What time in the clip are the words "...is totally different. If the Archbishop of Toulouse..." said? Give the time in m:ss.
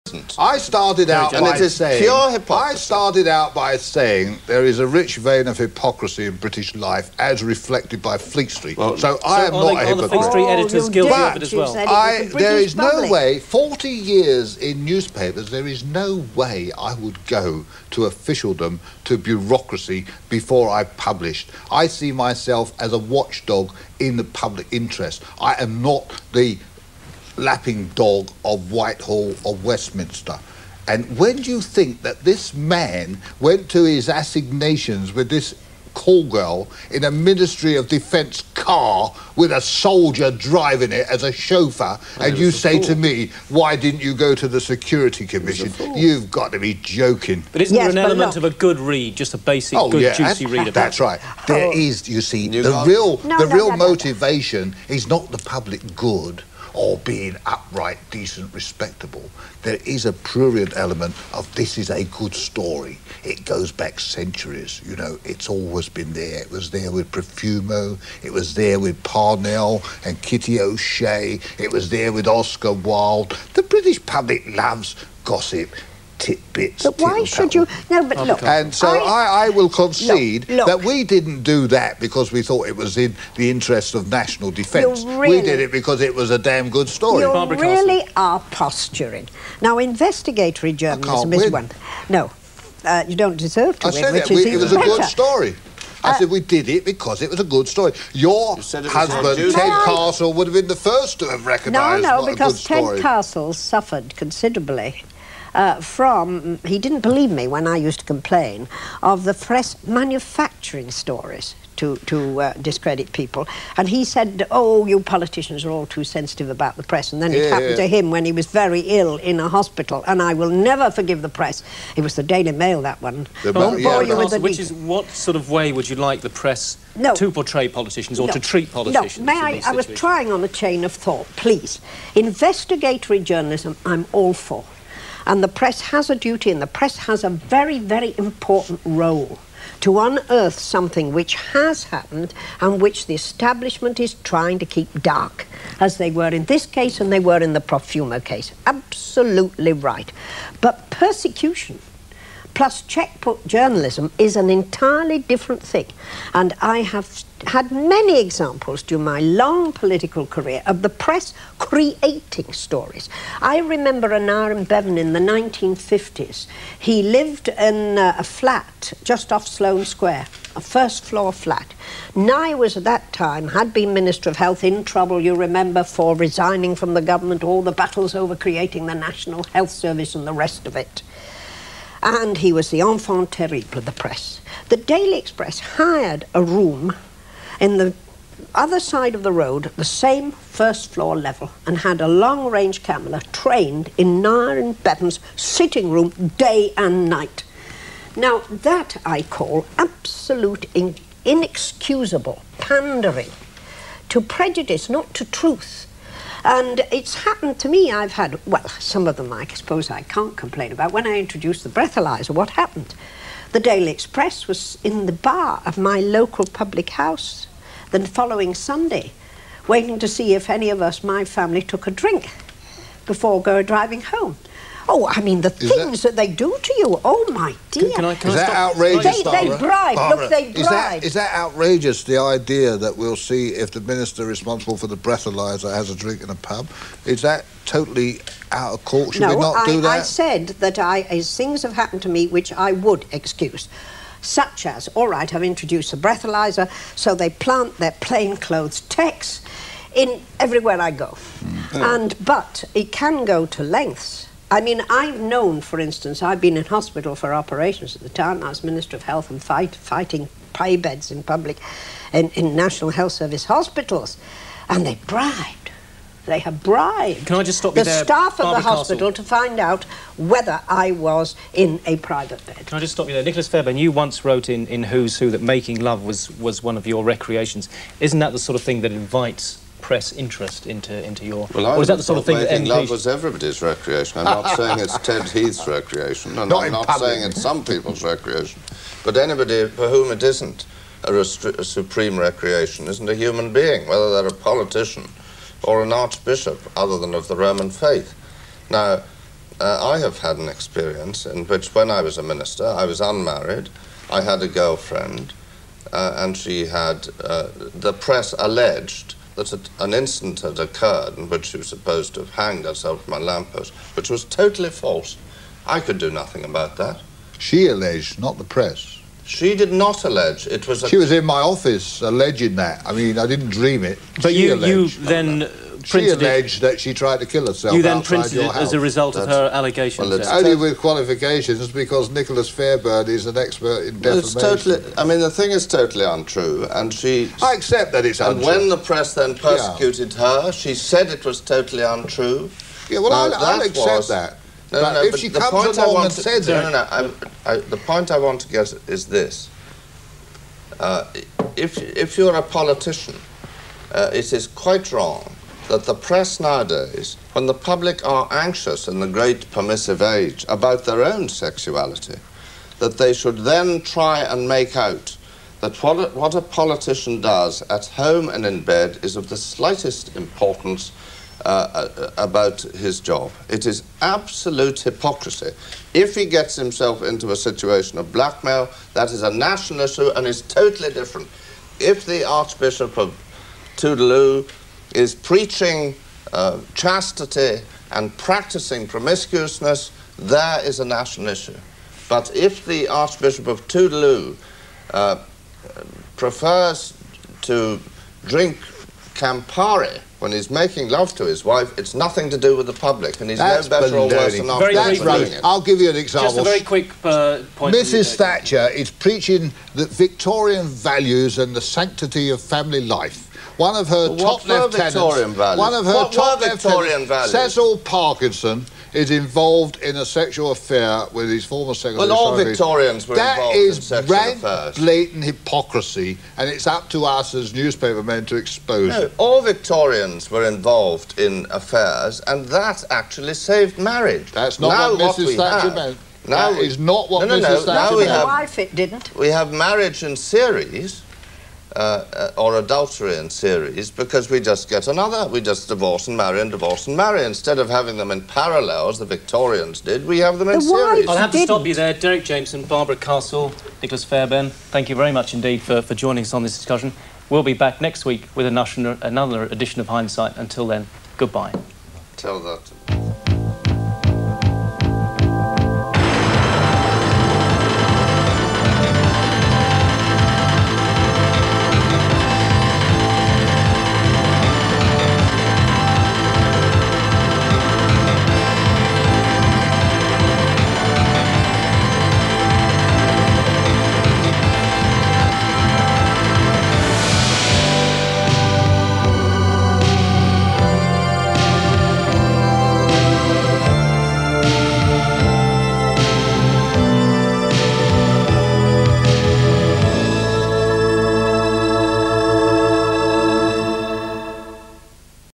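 6:20.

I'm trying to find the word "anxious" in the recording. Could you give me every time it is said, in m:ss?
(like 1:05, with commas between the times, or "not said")
5:58.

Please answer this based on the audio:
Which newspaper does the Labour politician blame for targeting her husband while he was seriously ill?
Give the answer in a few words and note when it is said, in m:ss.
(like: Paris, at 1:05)
Daily Mail, at 2:02.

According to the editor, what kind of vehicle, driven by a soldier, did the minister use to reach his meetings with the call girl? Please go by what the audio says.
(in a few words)
Ministry of Defence car.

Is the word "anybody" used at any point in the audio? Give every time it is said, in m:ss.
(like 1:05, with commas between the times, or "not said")
4:49.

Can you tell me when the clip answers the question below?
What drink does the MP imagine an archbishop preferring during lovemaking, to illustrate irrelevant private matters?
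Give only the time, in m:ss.
6:39.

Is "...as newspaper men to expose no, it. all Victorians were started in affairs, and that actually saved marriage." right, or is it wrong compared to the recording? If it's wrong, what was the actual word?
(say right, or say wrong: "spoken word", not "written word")
wrong: "involved", not "started".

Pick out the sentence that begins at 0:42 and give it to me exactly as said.
to me, why didn't you go to the Security Commission?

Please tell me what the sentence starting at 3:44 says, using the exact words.
Oh, I mean, the is things that, that, they do to you.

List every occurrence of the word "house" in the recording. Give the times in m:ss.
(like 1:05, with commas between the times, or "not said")
3:36, 5:28.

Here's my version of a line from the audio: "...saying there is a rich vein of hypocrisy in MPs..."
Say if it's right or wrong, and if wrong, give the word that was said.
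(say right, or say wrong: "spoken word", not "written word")
wrong: "British", not "MPs".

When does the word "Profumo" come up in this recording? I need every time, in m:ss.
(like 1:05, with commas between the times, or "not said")
1:07, 2:27.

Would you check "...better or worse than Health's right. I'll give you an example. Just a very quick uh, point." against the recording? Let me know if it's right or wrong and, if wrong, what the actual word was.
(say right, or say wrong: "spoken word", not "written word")
wrong: "That", not "Health".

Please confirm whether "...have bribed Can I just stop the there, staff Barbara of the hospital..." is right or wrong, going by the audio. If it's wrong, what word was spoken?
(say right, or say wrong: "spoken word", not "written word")
right.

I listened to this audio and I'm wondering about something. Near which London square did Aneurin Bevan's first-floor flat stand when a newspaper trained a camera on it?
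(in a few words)
Sloane Square.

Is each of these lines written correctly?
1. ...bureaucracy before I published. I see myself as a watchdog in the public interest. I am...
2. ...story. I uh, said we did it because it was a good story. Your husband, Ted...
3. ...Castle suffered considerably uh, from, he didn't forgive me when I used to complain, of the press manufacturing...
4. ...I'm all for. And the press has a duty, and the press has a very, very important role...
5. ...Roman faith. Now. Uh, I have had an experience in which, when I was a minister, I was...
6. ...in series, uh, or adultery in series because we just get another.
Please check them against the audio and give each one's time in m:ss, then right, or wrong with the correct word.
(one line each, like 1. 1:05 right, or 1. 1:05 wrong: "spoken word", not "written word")
1. 0:19 right
2. 1:35 right
3. 1:43 wrong: "believe", not "forgive"
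4. 2:13 right
5. 4:57 right
6. 7:20 right.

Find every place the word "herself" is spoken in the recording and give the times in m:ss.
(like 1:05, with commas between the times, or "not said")
5:12, 5:27.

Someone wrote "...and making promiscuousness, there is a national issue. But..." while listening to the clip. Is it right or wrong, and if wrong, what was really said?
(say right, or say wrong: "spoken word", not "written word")
wrong: "practicing", not "making".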